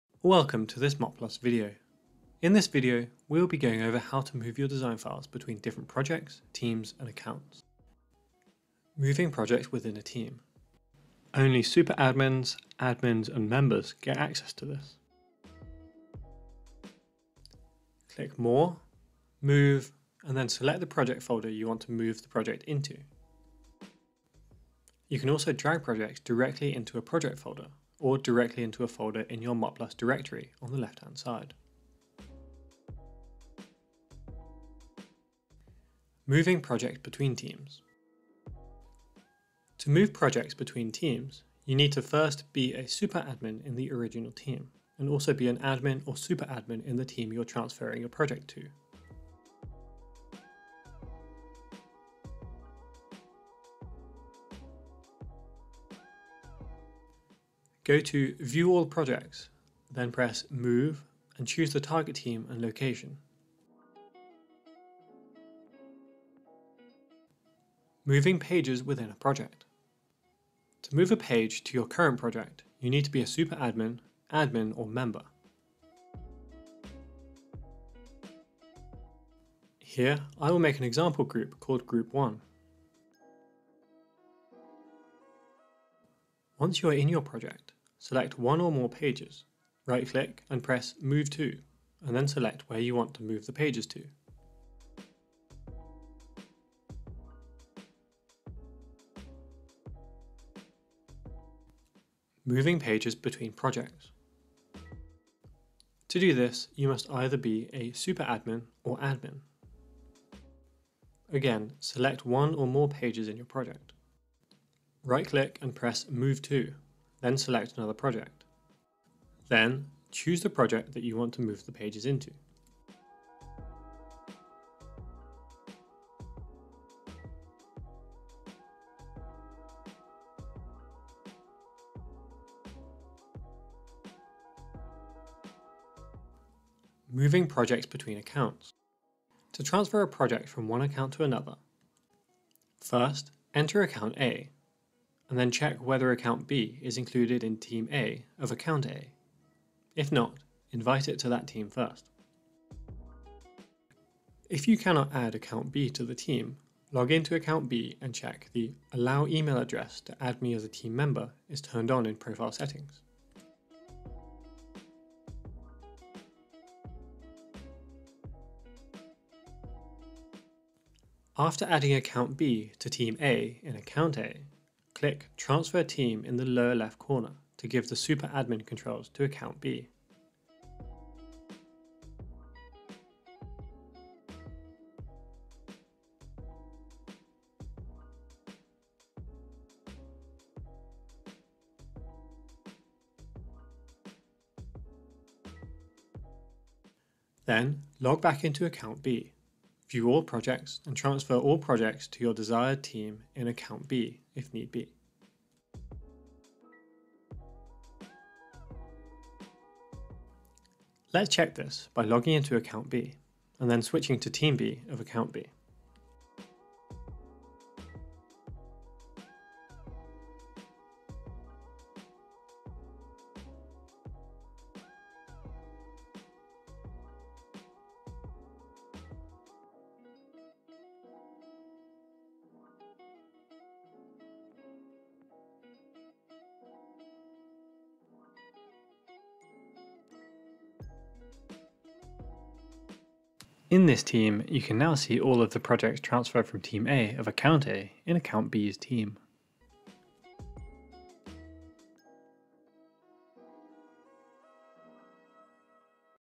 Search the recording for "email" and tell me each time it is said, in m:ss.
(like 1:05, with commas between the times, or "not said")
2:39.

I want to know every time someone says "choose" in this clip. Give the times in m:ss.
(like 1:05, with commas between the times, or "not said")
1:01, 2:00.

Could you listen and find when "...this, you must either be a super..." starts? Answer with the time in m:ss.
1:46.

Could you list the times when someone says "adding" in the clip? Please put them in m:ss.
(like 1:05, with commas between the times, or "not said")
2:51.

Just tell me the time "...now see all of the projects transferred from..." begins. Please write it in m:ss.
4:04.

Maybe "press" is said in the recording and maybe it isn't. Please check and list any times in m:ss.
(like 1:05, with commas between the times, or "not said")
1:00, 1:30, 1:55.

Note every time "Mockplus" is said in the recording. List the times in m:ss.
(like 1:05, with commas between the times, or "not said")
0:00, 0:29.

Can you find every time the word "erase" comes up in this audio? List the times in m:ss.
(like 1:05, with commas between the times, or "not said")
not said.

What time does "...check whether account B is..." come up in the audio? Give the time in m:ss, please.
2:25.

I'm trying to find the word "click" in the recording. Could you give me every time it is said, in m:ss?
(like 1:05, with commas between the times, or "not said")
0:18, 1:30, 1:55, 2:55.